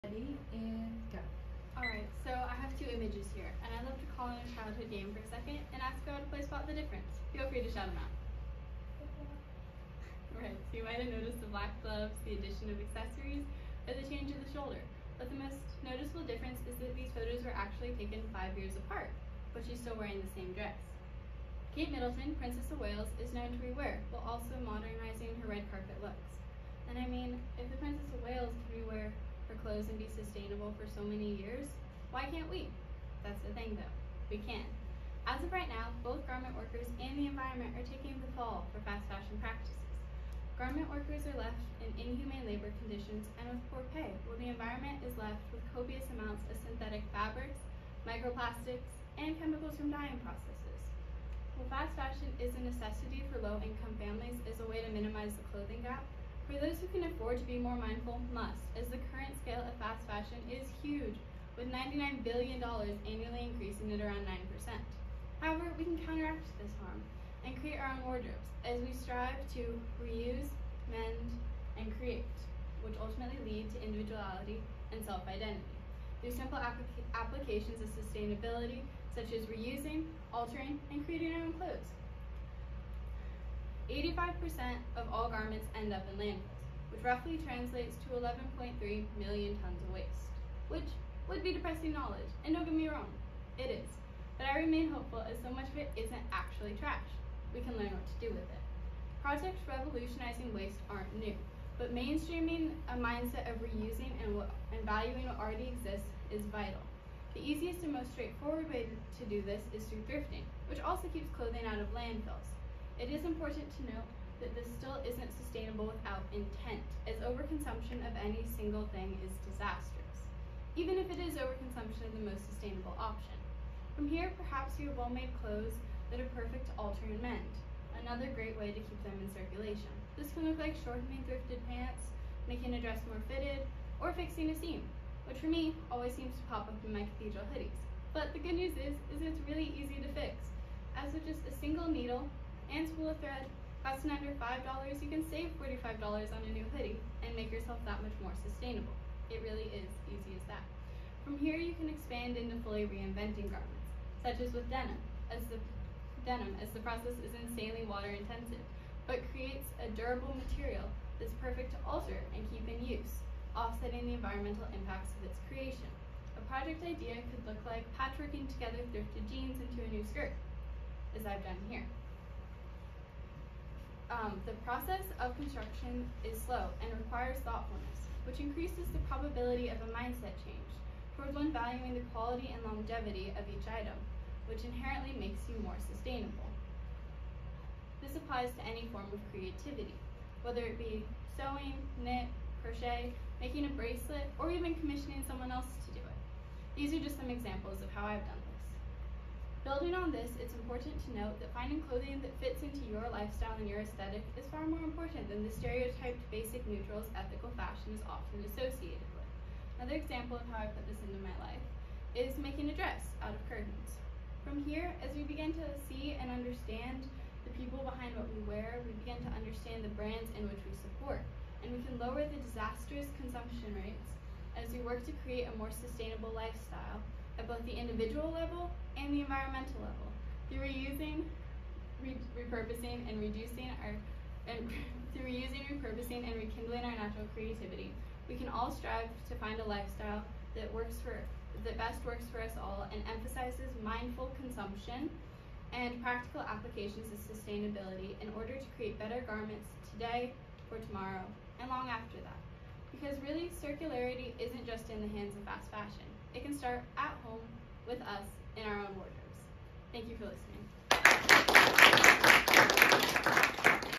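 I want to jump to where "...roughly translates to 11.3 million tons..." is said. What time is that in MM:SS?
01:27.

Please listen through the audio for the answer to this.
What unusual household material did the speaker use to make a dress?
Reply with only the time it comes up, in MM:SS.
03:33.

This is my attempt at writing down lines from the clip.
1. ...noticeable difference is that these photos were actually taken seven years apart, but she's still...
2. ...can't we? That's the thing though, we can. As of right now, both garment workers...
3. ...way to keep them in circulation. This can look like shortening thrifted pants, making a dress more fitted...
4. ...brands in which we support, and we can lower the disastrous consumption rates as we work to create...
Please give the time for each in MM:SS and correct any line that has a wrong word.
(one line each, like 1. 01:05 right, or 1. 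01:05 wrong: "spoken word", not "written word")
1. 00:15 wrong: "five", not "seven"
2. 00:32 right
3. 02:08 right
4. 03:39 right.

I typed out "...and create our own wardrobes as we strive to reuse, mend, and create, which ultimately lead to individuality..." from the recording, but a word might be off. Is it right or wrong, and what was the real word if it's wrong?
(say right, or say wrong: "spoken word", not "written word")
right.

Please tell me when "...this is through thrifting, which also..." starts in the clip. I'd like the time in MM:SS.
01:49.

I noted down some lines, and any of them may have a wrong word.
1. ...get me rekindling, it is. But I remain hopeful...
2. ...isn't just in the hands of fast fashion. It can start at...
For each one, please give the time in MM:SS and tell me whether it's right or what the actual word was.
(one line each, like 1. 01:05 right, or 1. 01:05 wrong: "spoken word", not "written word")
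1. 01:32 wrong: "wrong", not "rekindling"
2. 04:14 right.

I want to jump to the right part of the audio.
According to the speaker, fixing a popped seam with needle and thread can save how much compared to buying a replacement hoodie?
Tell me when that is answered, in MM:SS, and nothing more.
02:25.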